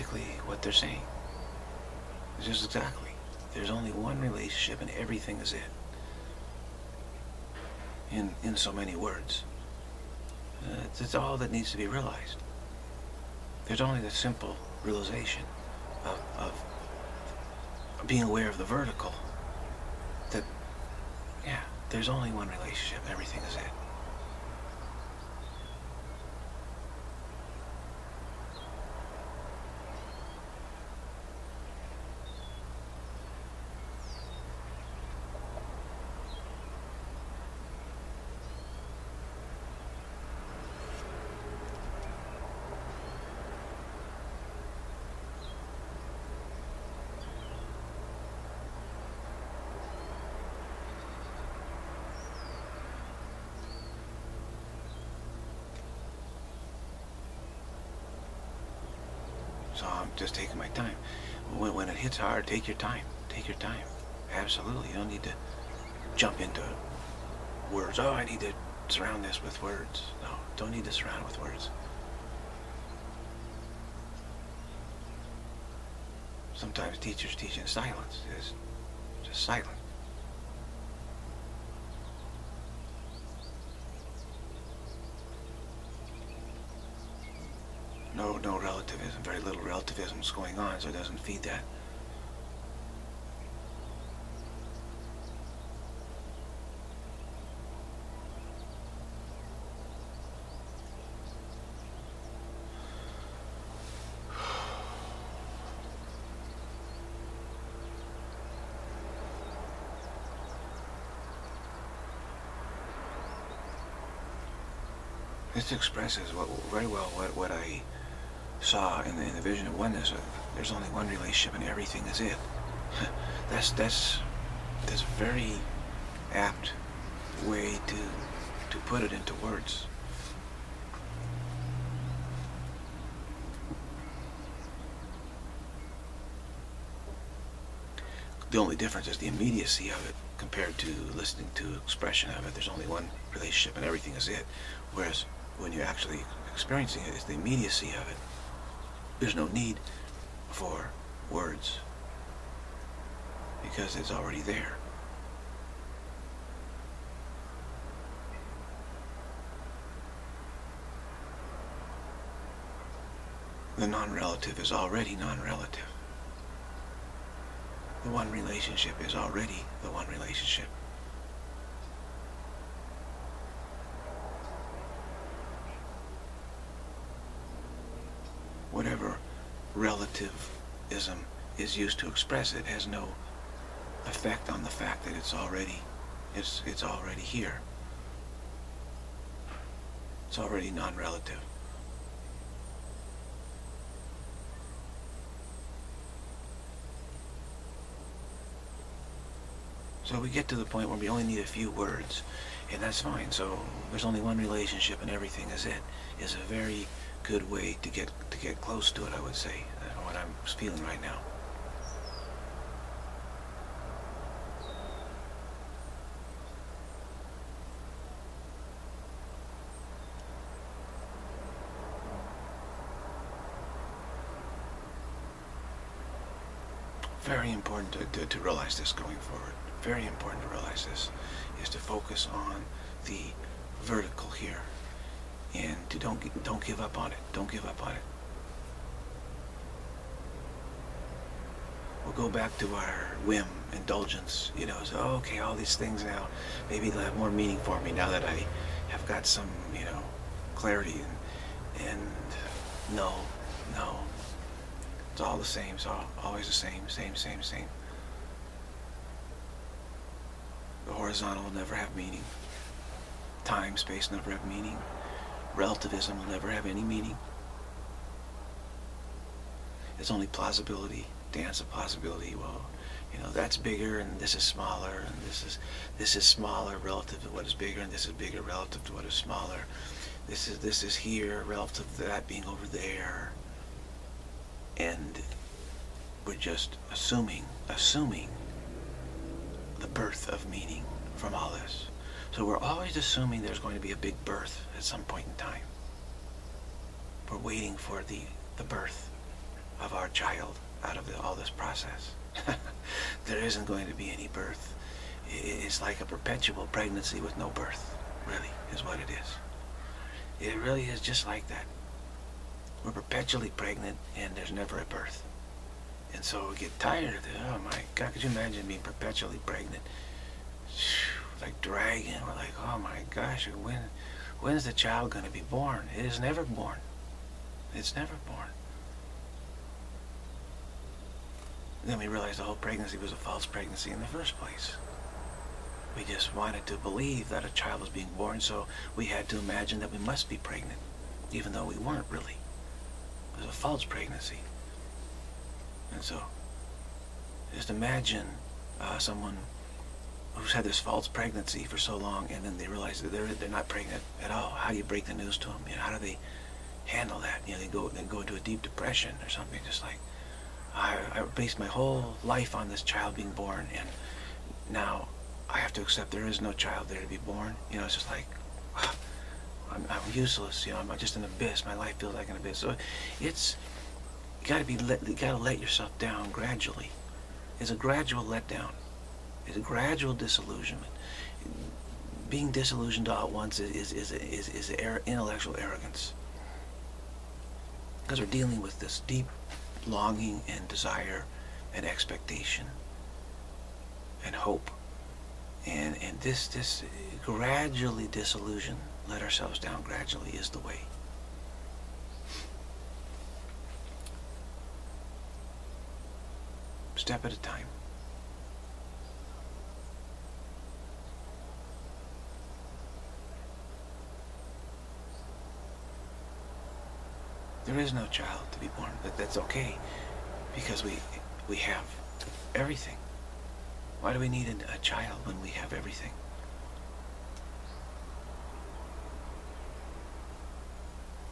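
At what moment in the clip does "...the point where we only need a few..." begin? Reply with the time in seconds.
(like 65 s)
200 s.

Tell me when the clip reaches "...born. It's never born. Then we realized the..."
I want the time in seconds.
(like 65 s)
326 s.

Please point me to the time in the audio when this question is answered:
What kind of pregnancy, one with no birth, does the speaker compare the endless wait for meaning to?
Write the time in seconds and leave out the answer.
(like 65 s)
306 s.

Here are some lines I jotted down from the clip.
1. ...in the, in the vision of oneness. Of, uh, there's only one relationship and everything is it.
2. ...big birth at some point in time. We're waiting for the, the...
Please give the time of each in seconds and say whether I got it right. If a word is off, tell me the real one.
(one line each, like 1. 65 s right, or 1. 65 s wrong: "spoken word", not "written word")
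1. 119 s right
2. 293 s right.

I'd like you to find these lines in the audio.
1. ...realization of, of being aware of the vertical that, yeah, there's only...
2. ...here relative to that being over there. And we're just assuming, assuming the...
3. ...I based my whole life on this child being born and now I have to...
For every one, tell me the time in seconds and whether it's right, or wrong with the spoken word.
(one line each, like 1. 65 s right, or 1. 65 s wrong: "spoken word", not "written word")
1. 14 s right
2. 280 s right
3. 361 s right.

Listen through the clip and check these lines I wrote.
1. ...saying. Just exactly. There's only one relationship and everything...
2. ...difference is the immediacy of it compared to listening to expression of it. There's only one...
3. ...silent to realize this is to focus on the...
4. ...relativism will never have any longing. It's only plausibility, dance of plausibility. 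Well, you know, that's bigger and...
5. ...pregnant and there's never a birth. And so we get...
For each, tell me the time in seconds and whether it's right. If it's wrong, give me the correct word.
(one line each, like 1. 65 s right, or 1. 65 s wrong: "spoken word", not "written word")
1. 0 s right
2. 138 s right
3. 230 s wrong: "important", not "silent"
4. 265 s wrong: "meaning", not "longing"
5. 313 s right.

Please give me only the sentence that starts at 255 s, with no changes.
It's all, always the same, same, same, same.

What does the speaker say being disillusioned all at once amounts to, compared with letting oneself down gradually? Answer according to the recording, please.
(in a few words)
intellectual arrogance.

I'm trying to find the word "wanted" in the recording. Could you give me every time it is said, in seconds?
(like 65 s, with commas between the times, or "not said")
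336 s.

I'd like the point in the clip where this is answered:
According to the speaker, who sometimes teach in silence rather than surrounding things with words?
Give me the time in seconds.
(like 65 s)
76 s.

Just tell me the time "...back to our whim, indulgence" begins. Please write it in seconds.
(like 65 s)
242 s.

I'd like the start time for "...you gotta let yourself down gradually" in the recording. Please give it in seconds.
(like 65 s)
375 s.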